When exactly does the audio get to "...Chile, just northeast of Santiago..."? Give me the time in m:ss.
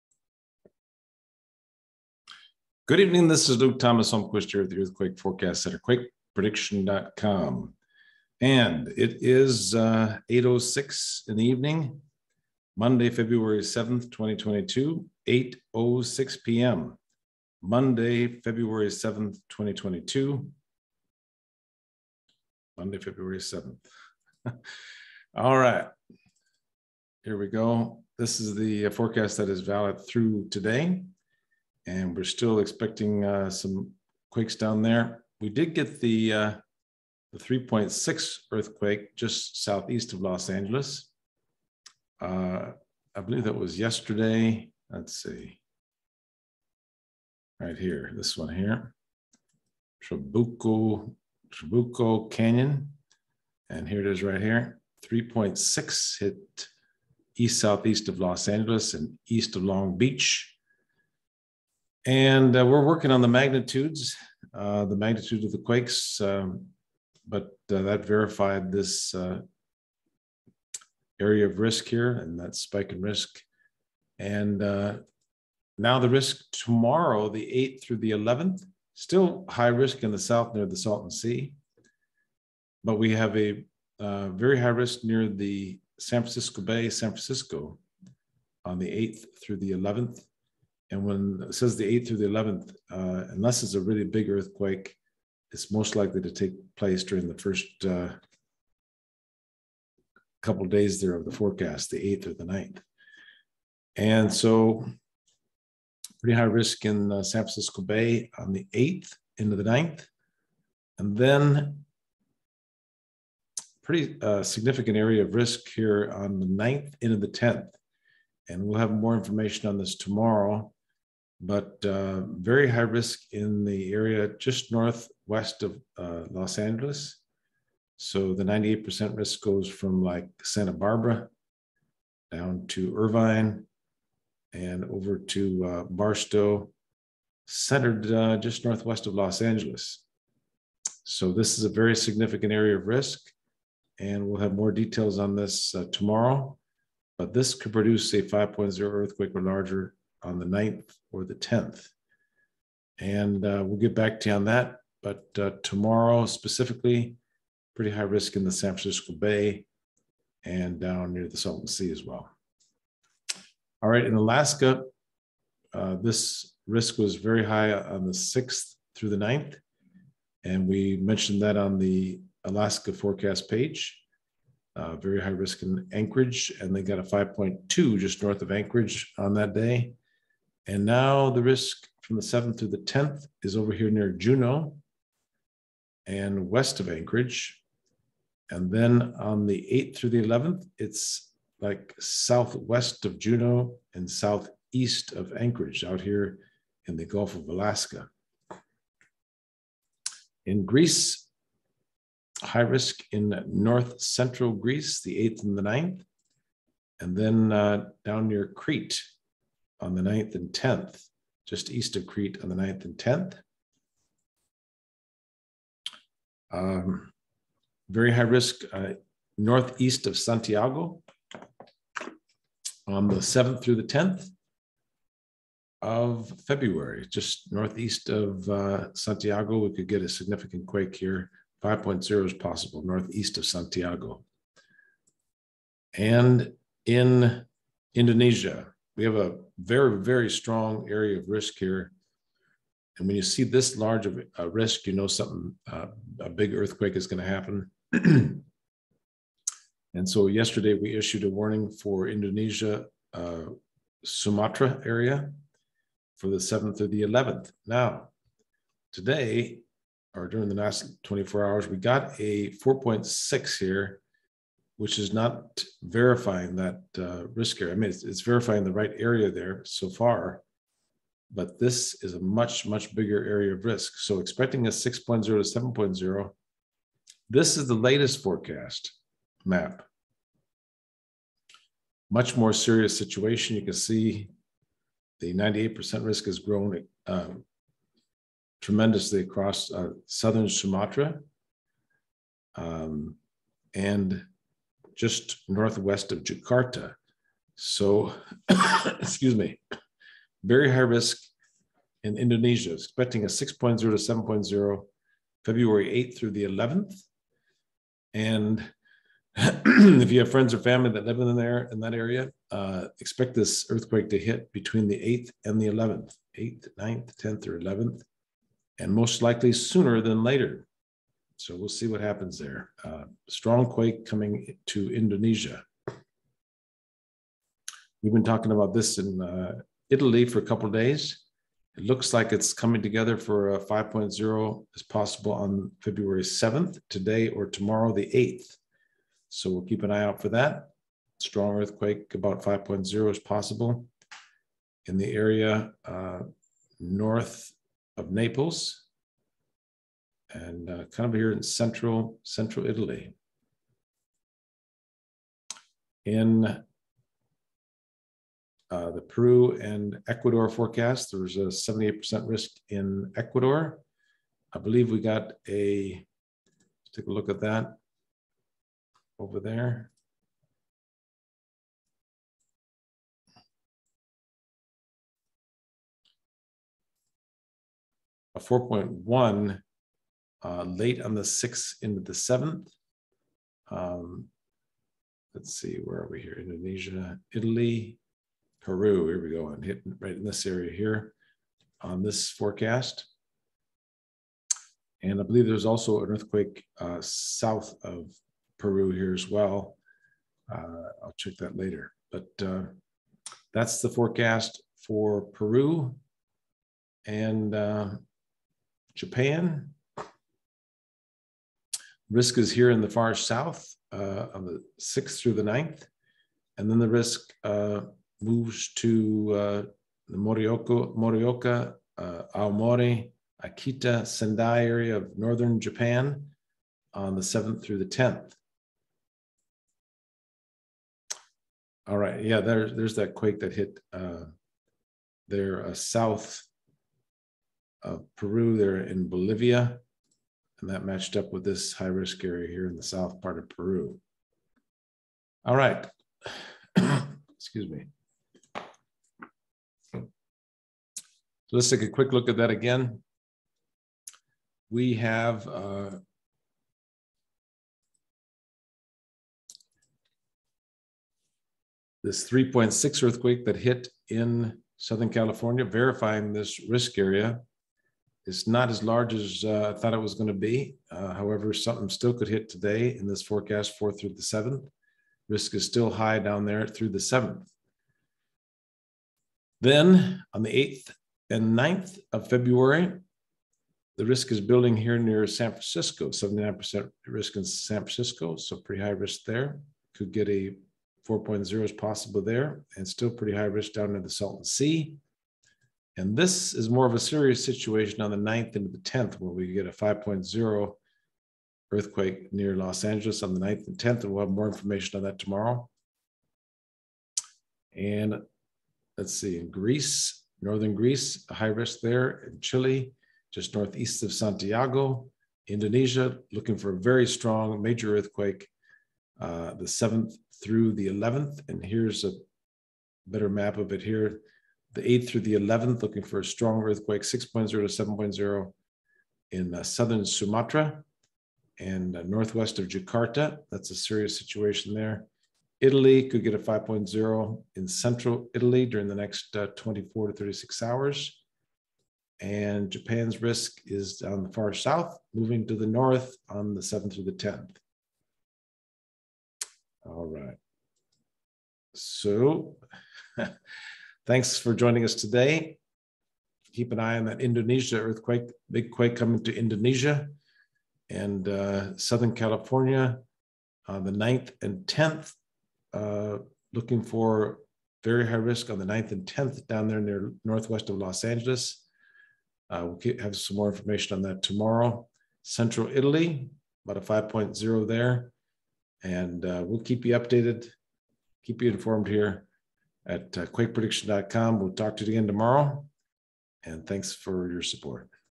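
8:32.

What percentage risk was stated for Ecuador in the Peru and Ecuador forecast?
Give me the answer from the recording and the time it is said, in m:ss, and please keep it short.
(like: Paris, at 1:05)
78%, at 6:01.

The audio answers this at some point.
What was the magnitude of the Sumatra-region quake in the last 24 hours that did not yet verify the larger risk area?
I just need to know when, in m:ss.
4:22.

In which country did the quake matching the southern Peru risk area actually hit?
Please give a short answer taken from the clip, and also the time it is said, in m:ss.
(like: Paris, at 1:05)
Bolivia, at 7:19.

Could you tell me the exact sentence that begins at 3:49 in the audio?
We could get a significant quake here.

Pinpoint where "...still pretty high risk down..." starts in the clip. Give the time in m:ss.
8:12.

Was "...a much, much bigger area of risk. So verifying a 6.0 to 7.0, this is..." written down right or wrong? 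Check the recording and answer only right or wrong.
wrong.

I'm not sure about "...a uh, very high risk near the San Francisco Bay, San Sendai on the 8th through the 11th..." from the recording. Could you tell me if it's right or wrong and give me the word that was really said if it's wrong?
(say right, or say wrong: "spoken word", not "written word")
wrong: "Francisco", not "Sendai".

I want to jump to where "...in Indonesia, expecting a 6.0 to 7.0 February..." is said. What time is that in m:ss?
5:02.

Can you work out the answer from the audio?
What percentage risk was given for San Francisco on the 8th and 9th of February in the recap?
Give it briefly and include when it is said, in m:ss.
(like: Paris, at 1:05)
79%, at 8:06.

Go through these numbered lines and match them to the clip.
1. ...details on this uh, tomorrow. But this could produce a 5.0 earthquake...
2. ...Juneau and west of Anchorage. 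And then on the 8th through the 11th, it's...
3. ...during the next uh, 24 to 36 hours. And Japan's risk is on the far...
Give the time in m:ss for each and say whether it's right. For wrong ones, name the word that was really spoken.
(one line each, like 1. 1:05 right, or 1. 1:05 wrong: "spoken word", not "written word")
1. 2:24 right
2. 3:04 right
3. 8:58 right.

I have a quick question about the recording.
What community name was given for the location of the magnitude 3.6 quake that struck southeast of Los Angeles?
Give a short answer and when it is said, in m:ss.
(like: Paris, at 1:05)
Trabuco Canyon, at 0:51.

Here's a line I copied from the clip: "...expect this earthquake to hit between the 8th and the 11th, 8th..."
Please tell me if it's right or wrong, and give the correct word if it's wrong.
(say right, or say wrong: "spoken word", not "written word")
right.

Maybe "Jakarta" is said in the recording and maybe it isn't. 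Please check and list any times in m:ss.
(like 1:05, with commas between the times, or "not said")
4:56, 8:52.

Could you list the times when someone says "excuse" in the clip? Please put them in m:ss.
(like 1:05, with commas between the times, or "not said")
4:58, 7:27.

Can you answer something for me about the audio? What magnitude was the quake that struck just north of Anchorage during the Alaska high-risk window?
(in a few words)
5.2.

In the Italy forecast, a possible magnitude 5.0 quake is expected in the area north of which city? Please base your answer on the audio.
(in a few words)
Naples.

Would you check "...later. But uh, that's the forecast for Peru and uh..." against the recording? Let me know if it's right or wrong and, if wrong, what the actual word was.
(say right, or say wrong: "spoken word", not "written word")
right.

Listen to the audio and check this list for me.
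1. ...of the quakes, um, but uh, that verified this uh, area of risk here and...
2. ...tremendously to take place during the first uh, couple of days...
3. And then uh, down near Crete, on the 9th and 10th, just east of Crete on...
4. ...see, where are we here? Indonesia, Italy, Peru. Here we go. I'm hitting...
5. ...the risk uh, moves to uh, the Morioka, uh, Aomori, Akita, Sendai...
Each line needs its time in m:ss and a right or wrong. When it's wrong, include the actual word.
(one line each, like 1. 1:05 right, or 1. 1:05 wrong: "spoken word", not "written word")
1. 1:05 right
2. 1:35 wrong: "likely", not "tremendously"
3. 3:26 right
4. 6:25 right
5. 6:56 right.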